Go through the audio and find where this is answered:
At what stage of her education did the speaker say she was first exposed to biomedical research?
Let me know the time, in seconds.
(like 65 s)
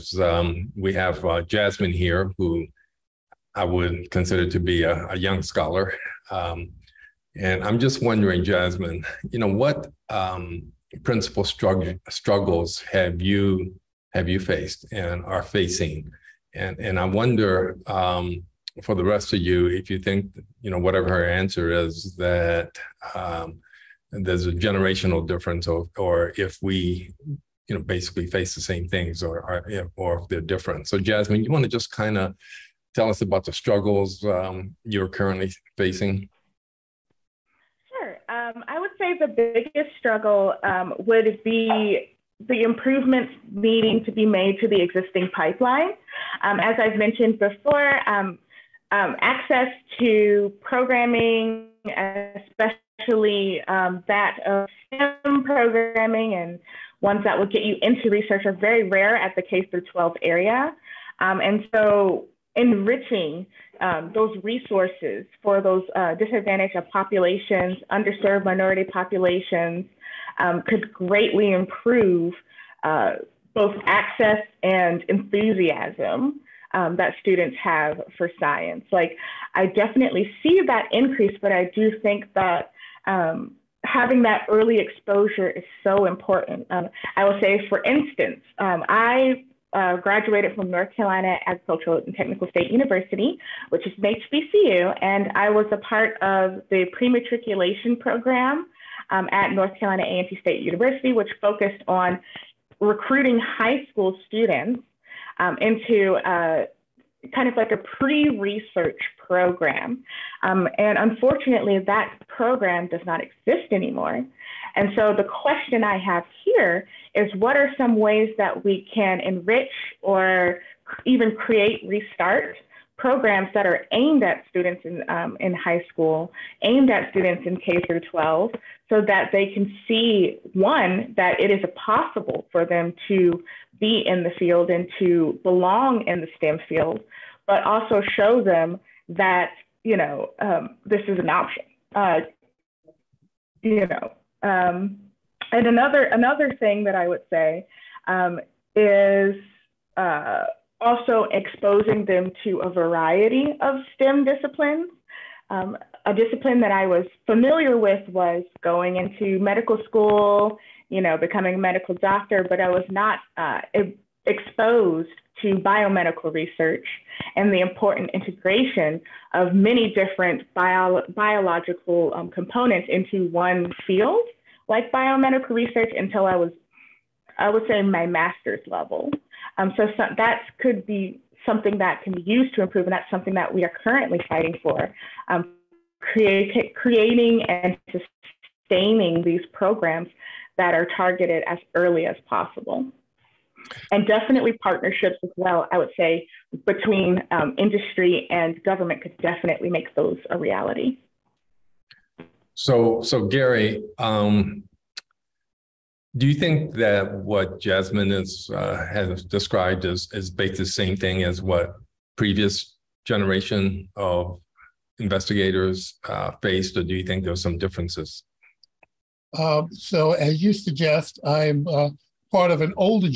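178 s.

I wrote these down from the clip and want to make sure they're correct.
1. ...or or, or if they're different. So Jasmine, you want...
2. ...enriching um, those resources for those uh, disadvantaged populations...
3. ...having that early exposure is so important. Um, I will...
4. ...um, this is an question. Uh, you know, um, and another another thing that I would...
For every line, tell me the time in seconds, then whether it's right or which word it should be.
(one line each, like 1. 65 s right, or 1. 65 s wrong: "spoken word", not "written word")
1. 29 s right
2. 62 s right
3. 83 s right
4. 140 s wrong: "option", not "question".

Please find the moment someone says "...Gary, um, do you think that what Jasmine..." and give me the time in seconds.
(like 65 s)
203 s.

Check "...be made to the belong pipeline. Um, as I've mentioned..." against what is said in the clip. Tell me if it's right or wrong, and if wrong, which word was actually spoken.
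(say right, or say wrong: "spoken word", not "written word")
wrong: "existing", not "belong".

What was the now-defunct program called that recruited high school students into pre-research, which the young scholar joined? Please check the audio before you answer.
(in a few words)
pre-matriculation program.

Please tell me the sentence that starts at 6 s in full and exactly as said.
Um, and I'm just wondering, Jasmine, you know, what um, principal strugg- struggles have you have you faced and are facing?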